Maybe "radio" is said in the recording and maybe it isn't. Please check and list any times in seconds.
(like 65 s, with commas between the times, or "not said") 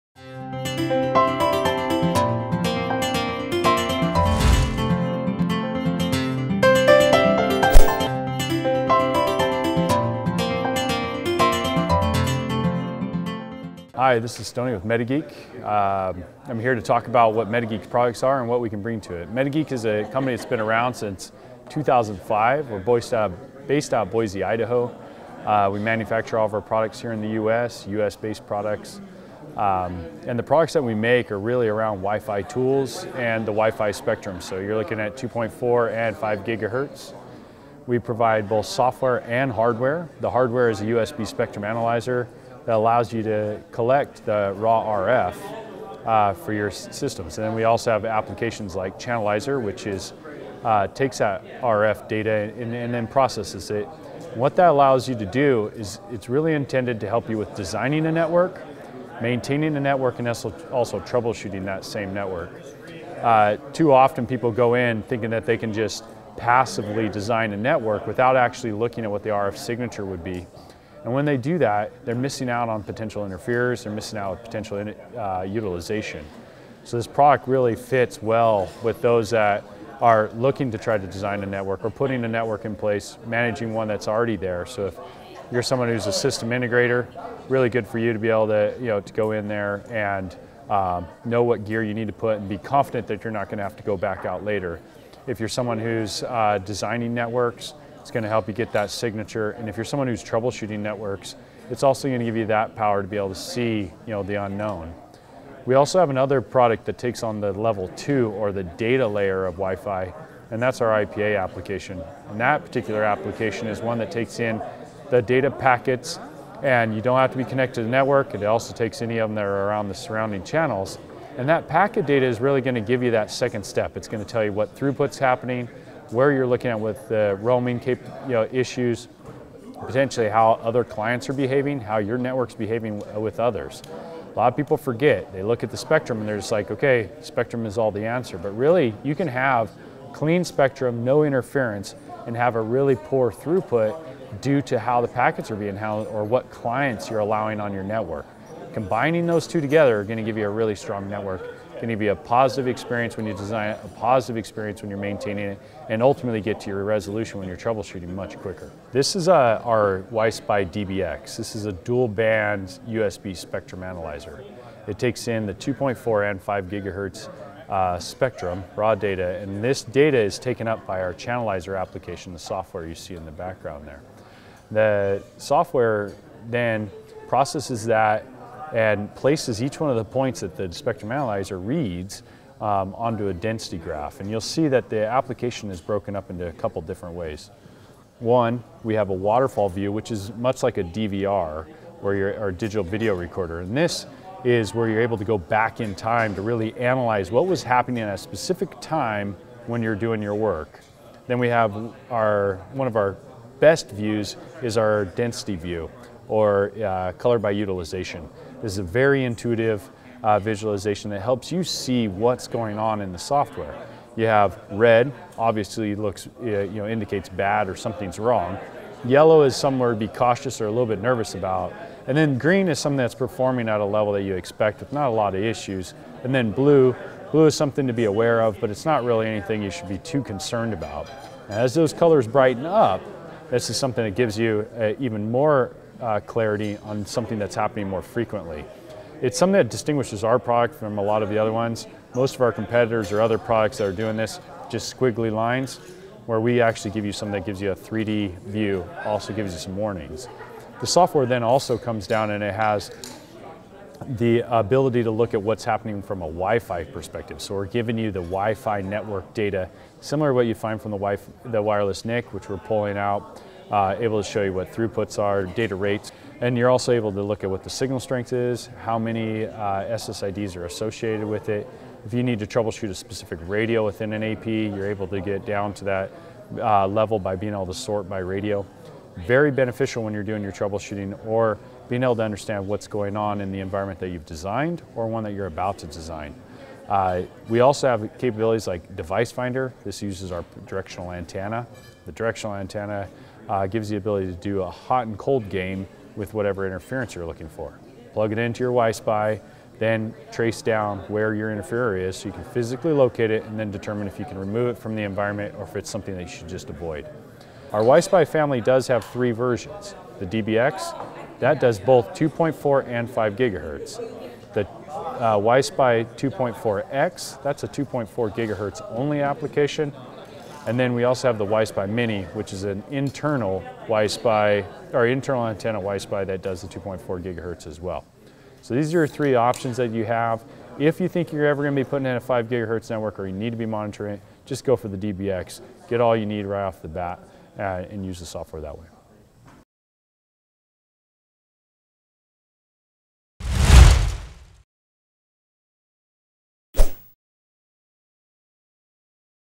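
273 s, 278 s.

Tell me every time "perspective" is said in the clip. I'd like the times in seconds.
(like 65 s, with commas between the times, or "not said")
256 s.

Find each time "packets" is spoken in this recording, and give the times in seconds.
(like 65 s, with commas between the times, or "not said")
115 s, 121 s, 145 s.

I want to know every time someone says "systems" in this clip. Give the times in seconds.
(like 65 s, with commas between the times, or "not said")
46 s, 86 s.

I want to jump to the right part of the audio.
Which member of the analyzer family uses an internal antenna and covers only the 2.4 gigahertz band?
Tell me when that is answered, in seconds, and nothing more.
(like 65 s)
321 s.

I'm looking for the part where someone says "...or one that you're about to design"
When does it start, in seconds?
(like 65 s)
284 s.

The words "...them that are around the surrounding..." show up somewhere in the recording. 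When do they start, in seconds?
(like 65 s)
119 s.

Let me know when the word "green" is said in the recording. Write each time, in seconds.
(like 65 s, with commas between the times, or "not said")
222 s.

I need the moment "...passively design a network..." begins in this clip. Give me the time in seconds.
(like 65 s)
66 s.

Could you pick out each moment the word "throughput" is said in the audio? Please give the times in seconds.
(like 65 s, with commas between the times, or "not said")
124 s, 143 s, 264 s.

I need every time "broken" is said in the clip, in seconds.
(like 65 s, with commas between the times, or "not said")
185 s.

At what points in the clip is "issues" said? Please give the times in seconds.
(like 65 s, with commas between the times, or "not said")
128 s, 225 s.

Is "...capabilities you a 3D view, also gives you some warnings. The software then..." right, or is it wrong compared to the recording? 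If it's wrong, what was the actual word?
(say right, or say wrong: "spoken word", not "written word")
wrong: "gives", not "capabilities".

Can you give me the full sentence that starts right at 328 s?
So these are your three options that you have.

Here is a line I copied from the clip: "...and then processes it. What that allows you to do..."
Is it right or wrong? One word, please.
right.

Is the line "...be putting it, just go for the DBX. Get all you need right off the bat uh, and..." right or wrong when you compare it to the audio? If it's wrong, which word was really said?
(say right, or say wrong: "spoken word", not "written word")
wrong: "monitoring", not "putting".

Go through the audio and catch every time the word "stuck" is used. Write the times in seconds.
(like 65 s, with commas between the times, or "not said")
not said.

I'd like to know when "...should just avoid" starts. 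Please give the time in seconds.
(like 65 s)
306 s.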